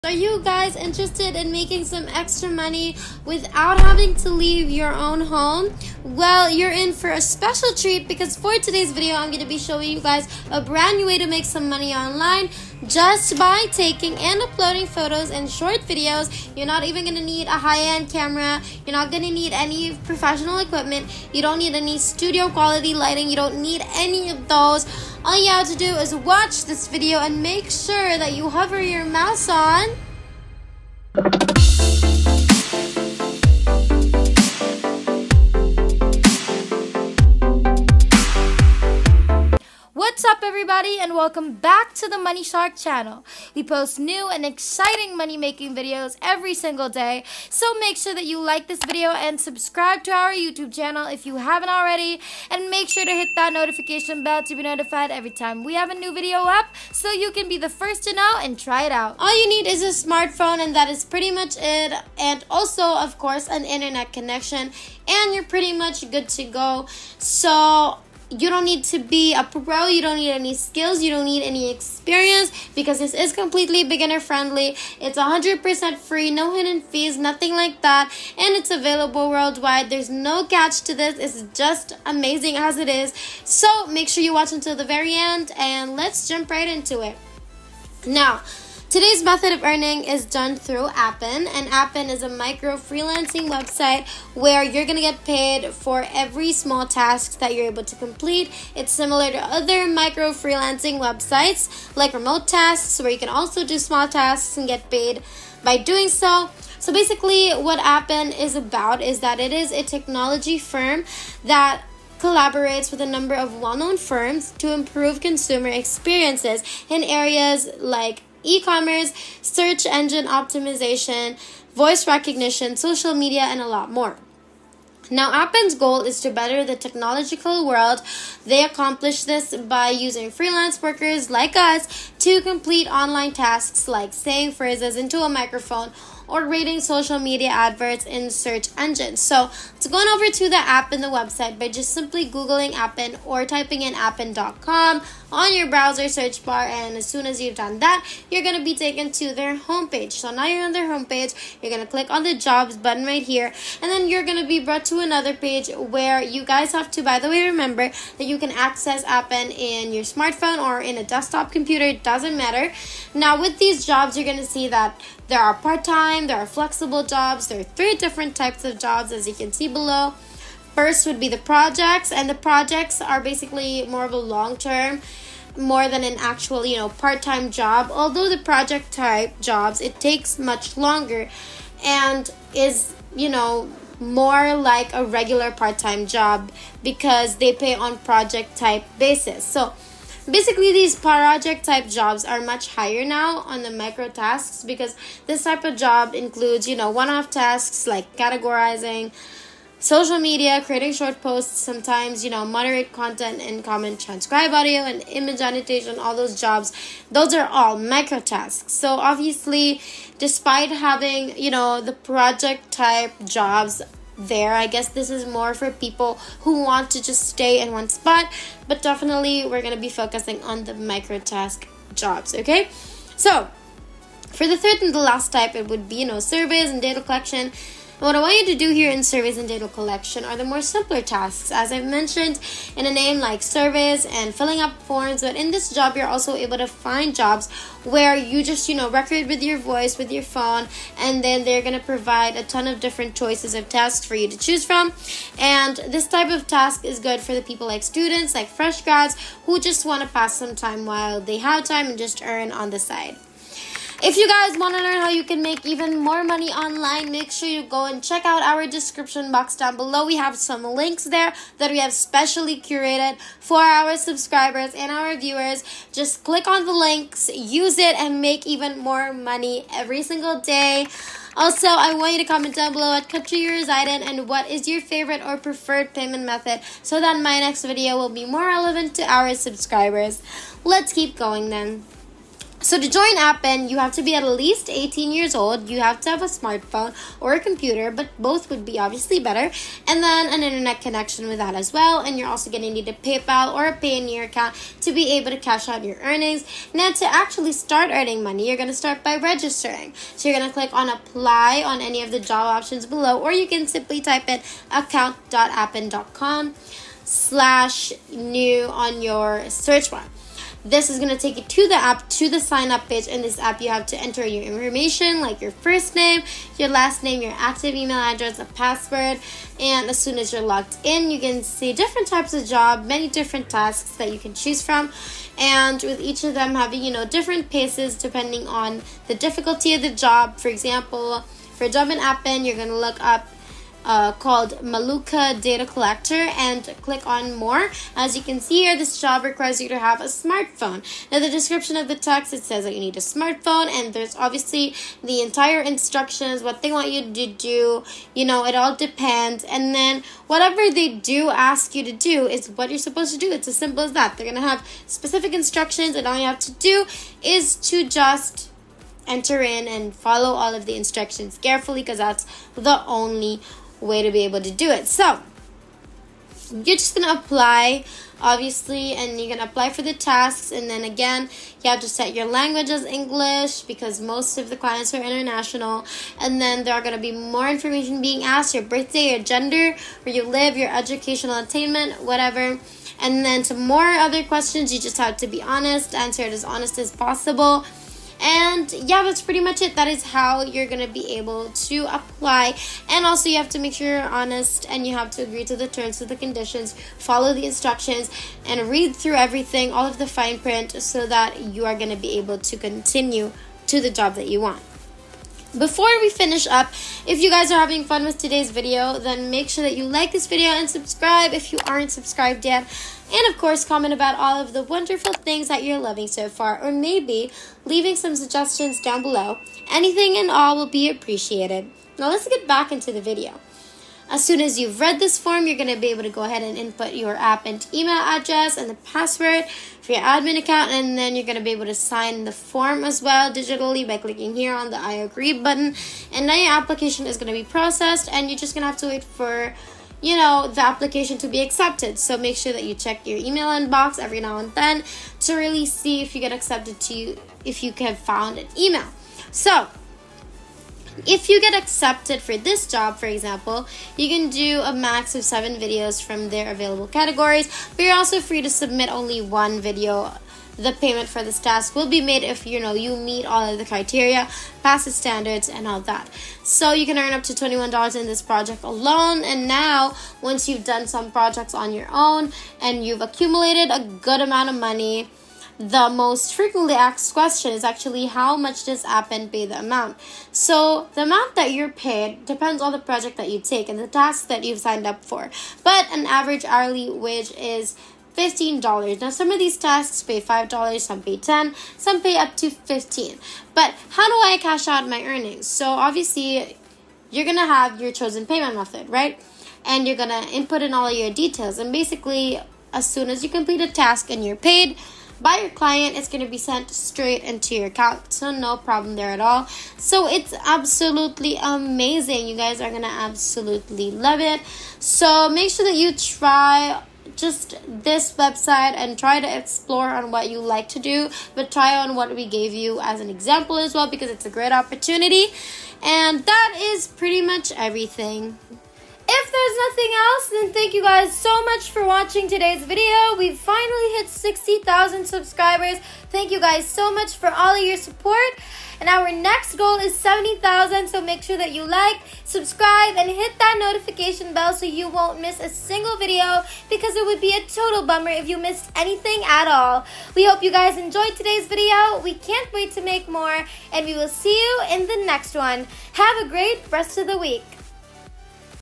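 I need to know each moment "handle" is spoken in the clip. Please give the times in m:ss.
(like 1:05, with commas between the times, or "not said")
not said.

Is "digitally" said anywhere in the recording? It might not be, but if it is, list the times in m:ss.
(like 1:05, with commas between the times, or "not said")
7:13.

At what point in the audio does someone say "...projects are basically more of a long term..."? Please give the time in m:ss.
2:52.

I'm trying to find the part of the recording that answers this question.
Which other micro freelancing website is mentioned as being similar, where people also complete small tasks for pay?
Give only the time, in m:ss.
1:42.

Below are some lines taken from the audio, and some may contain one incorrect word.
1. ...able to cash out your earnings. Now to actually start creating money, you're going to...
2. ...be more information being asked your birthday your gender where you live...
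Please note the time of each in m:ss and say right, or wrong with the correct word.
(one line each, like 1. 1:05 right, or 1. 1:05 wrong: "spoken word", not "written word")
1. 4:55 wrong: "earning", not "creating"
2. 6:16 right.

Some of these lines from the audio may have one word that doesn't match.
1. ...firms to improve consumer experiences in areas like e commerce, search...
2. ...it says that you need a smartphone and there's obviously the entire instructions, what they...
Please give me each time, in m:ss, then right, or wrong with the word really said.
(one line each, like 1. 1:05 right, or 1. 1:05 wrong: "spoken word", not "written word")
1. 1:53 right
2. 5:42 right.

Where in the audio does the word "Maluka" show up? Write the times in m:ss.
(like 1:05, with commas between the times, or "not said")
5:34.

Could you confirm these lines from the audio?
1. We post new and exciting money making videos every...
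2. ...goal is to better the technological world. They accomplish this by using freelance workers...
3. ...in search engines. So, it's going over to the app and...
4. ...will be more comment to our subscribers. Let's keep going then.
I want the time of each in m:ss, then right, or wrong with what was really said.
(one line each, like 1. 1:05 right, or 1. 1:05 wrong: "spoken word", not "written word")
1. 0:43 right
2. 2:05 right
3. 2:18 right
4. 4:37 wrong: "relevant", not "comment".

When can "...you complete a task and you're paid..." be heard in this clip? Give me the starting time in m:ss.
8:23.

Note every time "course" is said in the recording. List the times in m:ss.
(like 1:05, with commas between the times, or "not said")
1:03, 6:53.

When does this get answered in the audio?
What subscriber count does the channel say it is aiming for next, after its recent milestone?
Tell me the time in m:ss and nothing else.
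8:59.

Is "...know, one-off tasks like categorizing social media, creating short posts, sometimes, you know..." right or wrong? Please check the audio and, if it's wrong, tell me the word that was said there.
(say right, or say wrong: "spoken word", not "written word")
right.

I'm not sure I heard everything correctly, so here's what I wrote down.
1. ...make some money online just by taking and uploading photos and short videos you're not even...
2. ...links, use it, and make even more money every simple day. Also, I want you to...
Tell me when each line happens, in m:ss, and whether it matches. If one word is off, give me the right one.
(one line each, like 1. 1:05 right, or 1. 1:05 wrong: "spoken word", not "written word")
1. 0:11 right
2. 4:26 wrong: "single", not "simple".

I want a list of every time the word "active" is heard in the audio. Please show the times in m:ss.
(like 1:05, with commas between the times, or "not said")
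5:17.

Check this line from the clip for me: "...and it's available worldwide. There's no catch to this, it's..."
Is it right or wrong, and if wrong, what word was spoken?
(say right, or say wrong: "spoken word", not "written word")
right.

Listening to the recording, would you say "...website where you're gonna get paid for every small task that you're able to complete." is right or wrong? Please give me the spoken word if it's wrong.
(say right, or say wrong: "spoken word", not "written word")
right.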